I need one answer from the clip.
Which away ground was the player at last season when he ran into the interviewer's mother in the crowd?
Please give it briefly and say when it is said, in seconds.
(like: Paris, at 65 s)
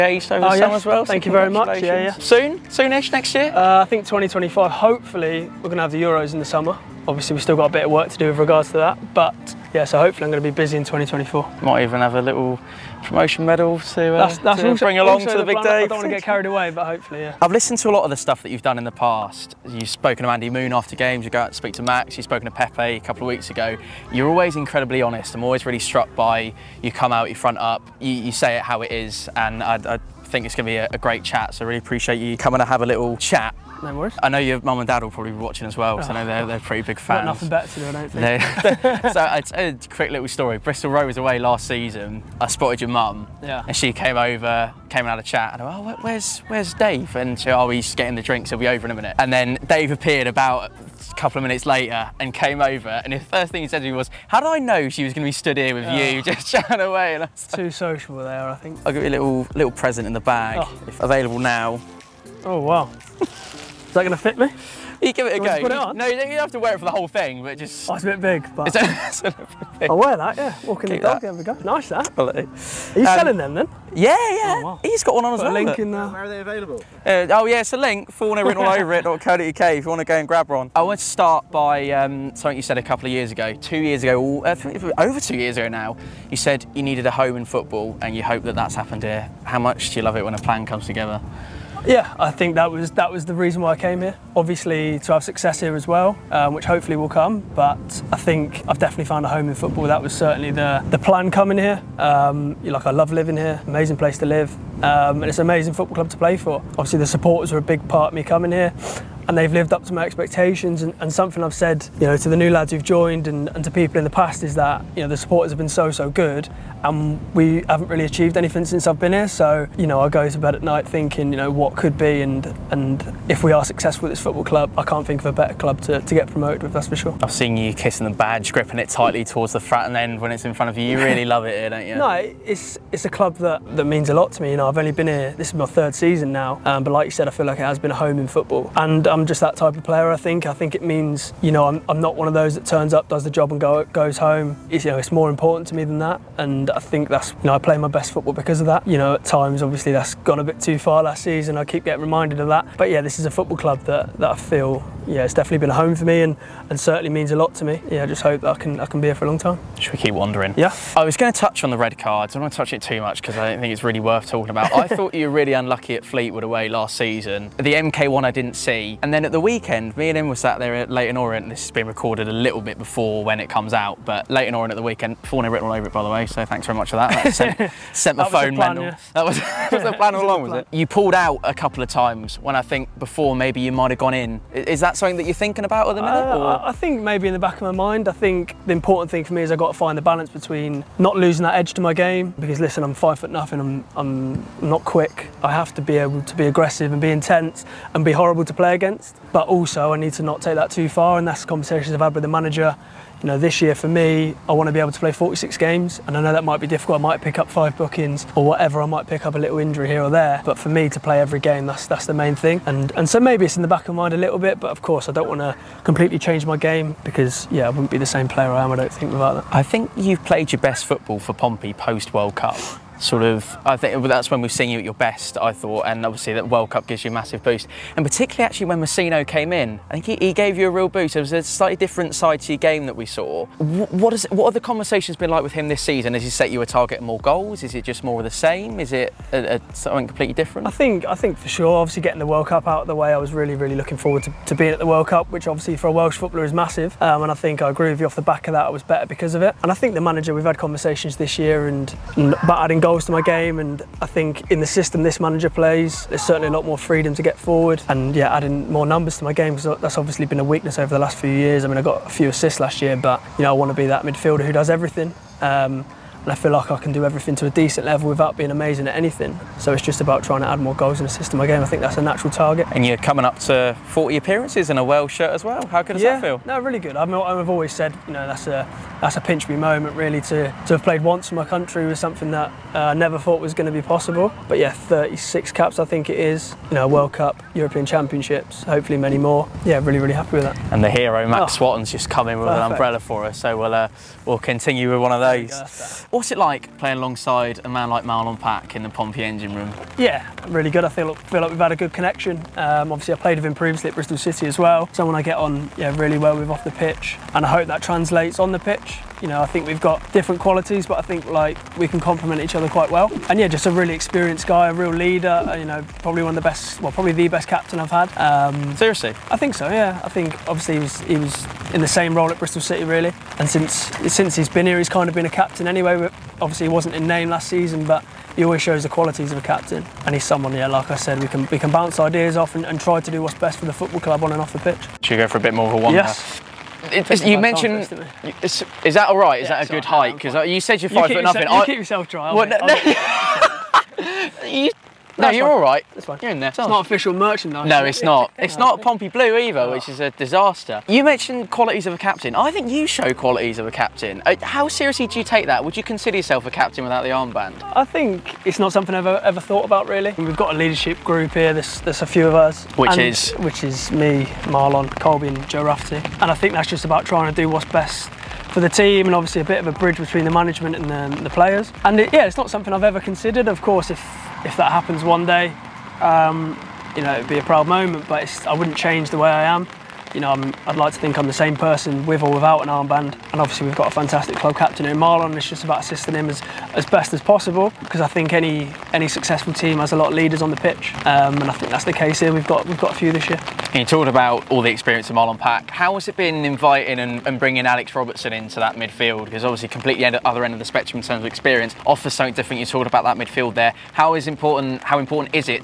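Bristol Rovers, at 40 s.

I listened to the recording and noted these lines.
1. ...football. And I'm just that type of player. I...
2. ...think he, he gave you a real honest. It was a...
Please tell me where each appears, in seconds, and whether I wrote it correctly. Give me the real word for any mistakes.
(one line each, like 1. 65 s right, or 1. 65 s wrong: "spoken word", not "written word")
1. 138 s right
2. 229 s wrong: "boost", not "honest".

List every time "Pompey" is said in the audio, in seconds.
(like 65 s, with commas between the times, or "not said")
221 s, 298 s, 348 s.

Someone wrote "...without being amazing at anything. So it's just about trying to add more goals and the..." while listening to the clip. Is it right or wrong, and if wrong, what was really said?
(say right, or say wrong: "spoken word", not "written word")
right.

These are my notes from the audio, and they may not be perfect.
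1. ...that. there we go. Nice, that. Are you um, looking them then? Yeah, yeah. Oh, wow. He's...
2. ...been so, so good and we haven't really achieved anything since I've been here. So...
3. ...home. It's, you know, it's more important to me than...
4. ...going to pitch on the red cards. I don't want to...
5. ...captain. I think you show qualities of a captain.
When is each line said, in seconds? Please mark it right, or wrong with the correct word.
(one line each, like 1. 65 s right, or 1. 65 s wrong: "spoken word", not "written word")
1. 71 s wrong: "selling", not "looking"
2. 115 s right
3. 144 s right
4. 161 s wrong: "touch", not "pitch"
5. 351 s right.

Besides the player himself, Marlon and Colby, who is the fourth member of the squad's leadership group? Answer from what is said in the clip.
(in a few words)
Joe Rafferty.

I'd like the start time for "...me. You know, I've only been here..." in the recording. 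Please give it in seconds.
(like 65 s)
134 s.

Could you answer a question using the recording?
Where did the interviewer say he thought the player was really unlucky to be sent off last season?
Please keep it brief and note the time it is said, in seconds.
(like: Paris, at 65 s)
Fleetwood, at 166 s.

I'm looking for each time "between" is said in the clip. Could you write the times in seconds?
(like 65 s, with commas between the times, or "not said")
190 s, 369 s.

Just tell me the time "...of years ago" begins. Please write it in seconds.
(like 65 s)
83 s.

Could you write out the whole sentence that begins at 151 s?
I keep getting reminded of that.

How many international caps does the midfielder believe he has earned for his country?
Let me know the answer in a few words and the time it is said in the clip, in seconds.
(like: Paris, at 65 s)
36, at 284 s.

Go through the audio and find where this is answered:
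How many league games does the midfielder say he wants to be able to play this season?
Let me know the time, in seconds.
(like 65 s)
205 s.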